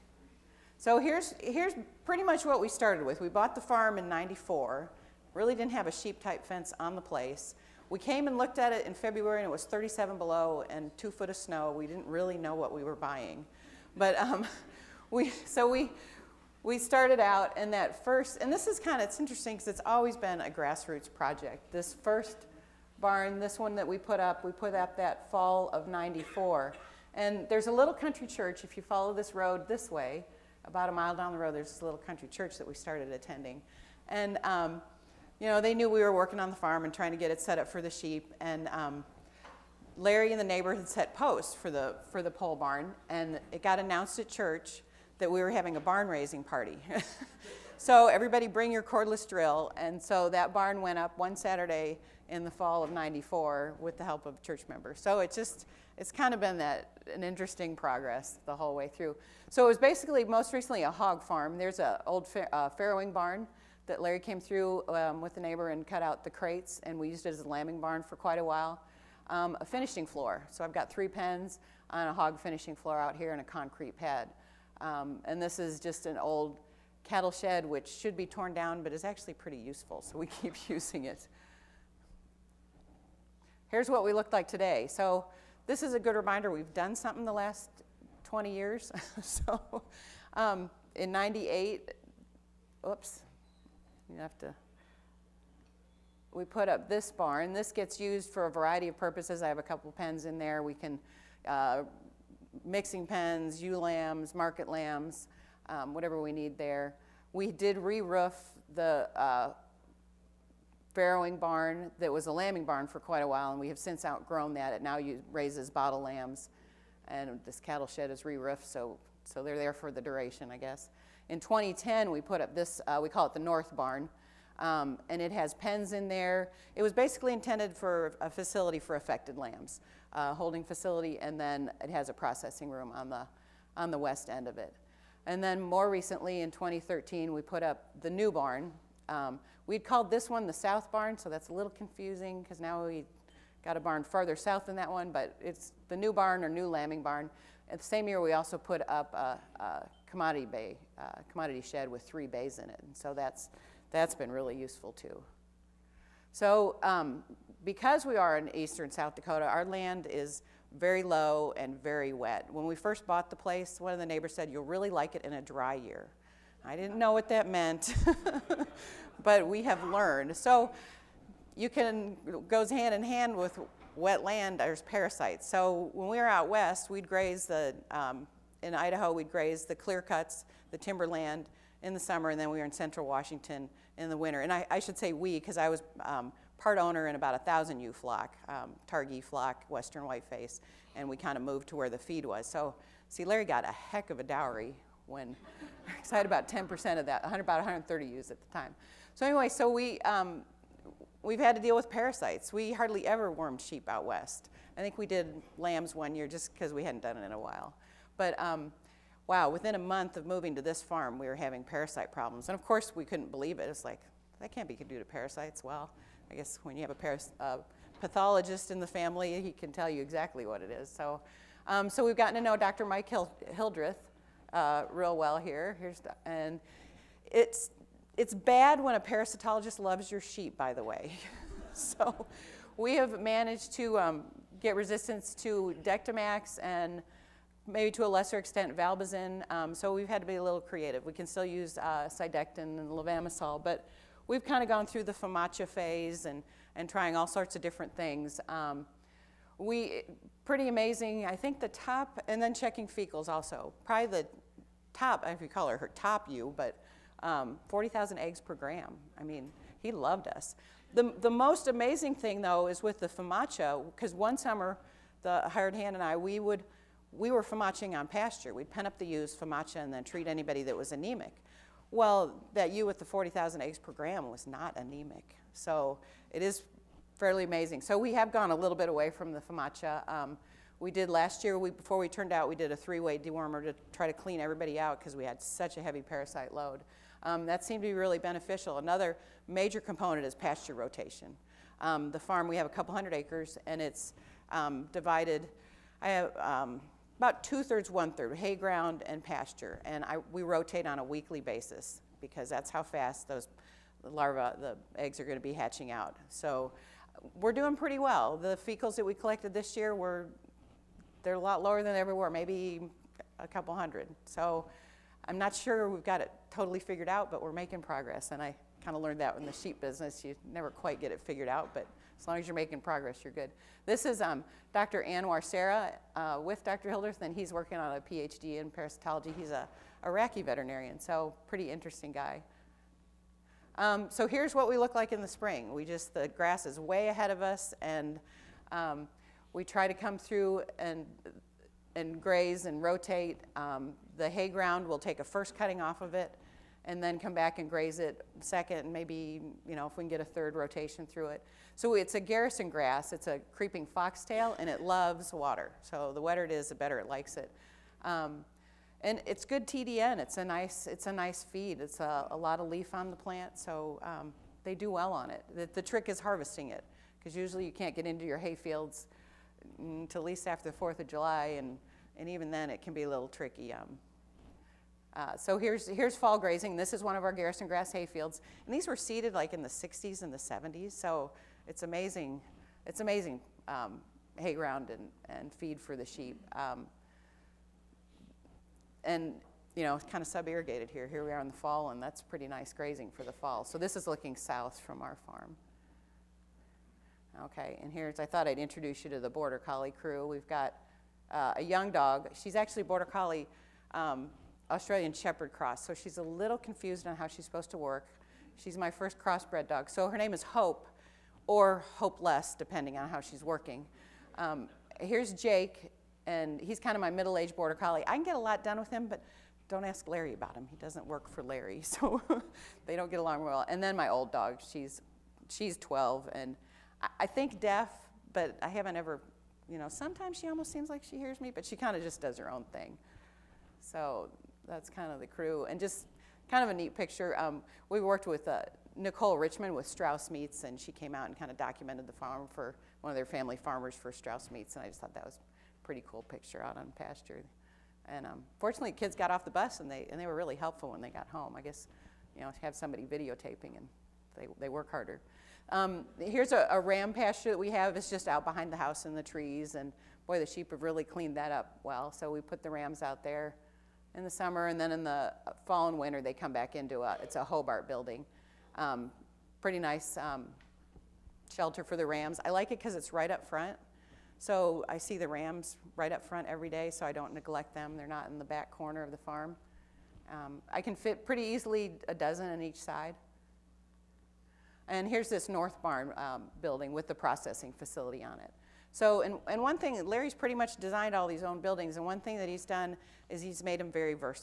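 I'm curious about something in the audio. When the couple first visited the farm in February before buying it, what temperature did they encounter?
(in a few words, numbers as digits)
37 below.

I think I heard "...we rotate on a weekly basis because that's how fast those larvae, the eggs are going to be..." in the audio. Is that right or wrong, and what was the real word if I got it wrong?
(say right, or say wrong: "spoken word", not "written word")
right.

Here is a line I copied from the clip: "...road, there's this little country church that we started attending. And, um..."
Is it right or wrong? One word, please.
right.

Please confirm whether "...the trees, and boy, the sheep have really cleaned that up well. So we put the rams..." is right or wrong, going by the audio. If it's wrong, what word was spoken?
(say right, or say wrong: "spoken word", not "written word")
right.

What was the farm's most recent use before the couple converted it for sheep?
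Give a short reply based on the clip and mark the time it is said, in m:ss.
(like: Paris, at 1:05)
hog farm, at 1:00.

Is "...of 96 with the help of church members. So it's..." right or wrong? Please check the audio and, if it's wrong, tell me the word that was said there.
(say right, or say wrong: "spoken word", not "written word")
wrong: "94", not "96".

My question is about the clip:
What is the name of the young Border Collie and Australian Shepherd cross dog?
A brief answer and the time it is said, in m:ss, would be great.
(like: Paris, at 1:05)
Hope, at 6:50.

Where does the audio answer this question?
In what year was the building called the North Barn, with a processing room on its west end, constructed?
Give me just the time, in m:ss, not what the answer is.
2:01.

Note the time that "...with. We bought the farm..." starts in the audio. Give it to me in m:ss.
0:03.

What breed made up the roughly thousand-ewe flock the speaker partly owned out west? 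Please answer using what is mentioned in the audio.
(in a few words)
Targhee.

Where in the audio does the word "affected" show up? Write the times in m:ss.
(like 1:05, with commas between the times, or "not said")
2:08.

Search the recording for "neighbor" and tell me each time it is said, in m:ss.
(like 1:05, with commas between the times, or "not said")
0:40, 1:05, 2:44.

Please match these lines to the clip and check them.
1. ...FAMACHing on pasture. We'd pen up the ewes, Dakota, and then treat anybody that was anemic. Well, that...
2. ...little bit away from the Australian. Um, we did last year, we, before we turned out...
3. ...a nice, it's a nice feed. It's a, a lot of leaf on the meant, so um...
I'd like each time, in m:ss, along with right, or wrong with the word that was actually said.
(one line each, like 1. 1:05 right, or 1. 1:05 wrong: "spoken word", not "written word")
1. 4:27 wrong: "FAMACHA", not "Dakota"
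2. 4:38 wrong: "FAMACHA", not "Australian"
3. 6:00 wrong: "plant", not "meant".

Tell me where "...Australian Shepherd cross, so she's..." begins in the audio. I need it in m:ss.
6:44.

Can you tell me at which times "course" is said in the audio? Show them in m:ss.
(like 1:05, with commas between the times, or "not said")
3:32.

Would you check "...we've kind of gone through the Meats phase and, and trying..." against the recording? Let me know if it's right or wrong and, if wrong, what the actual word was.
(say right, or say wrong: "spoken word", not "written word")
wrong: "FAMACHA", not "Meats".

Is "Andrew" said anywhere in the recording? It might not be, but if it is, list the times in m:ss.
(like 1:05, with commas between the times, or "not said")
not said.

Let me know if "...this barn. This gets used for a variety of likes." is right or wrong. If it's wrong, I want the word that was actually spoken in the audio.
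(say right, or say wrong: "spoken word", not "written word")
wrong: "purposes", not "likes".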